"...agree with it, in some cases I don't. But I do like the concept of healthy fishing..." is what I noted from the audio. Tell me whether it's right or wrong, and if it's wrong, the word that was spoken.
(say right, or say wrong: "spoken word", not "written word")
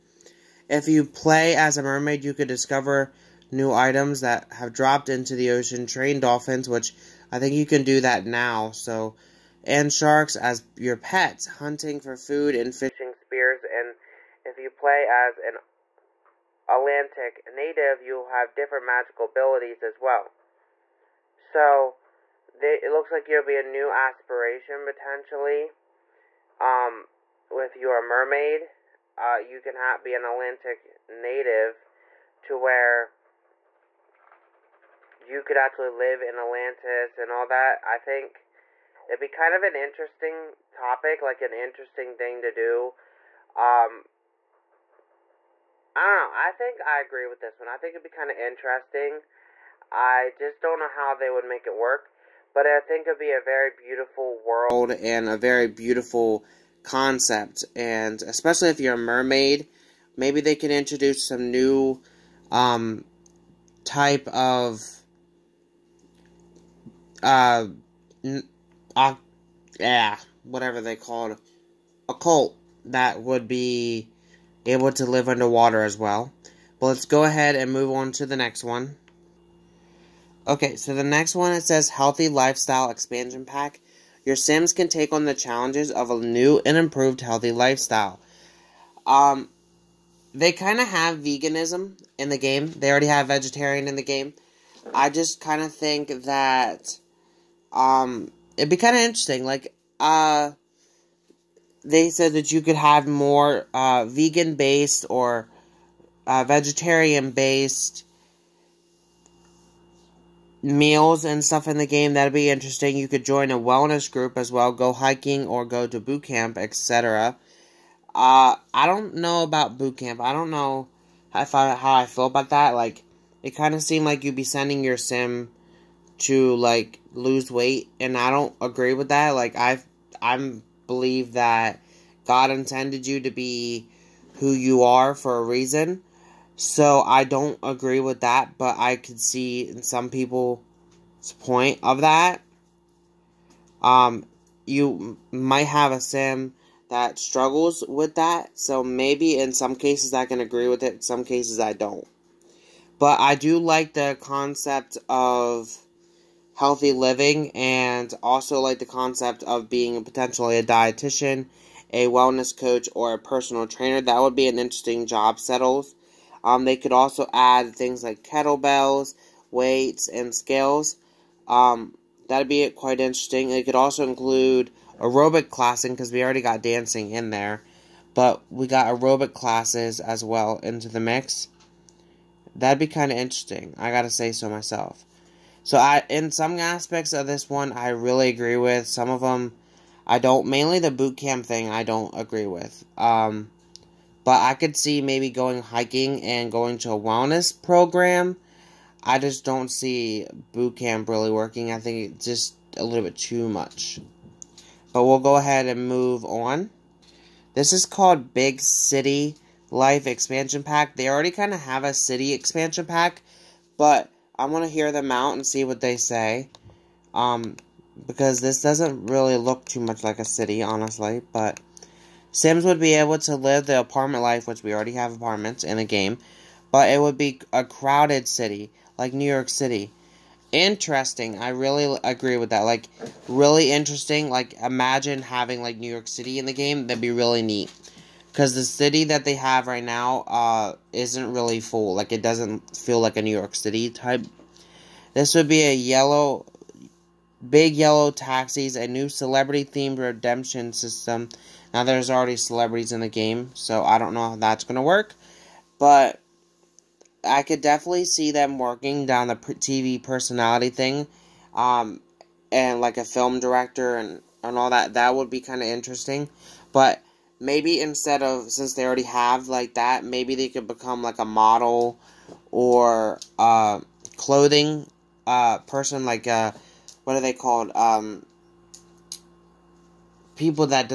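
wrong: "living", not "fishing".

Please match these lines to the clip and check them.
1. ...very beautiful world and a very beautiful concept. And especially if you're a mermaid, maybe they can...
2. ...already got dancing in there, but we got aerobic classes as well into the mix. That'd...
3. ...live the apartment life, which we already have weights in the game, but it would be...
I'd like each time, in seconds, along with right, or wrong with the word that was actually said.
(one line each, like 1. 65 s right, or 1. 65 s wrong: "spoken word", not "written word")
1. 53 s right
2. 176 s right
3. 223 s wrong: "apartments", not "weights".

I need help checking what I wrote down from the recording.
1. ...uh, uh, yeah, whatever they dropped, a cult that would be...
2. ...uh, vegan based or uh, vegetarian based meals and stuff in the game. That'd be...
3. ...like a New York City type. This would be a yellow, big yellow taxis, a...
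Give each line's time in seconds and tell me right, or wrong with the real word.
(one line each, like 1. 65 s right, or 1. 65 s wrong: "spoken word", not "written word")
1. 67 s wrong: "called", not "dropped"
2. 103 s right
3. 242 s right.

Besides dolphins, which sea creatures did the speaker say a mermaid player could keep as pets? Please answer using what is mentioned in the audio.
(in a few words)
Sharks.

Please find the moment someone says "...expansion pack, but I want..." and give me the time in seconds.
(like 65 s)
212 s.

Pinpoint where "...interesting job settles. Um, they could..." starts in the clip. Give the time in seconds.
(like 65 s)
164 s.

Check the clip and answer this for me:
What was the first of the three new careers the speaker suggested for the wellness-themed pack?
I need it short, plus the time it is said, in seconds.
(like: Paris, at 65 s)
Dietitian, at 160 s.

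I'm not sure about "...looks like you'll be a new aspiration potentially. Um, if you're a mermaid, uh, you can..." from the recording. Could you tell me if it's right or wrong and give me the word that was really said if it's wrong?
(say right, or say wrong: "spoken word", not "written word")
right.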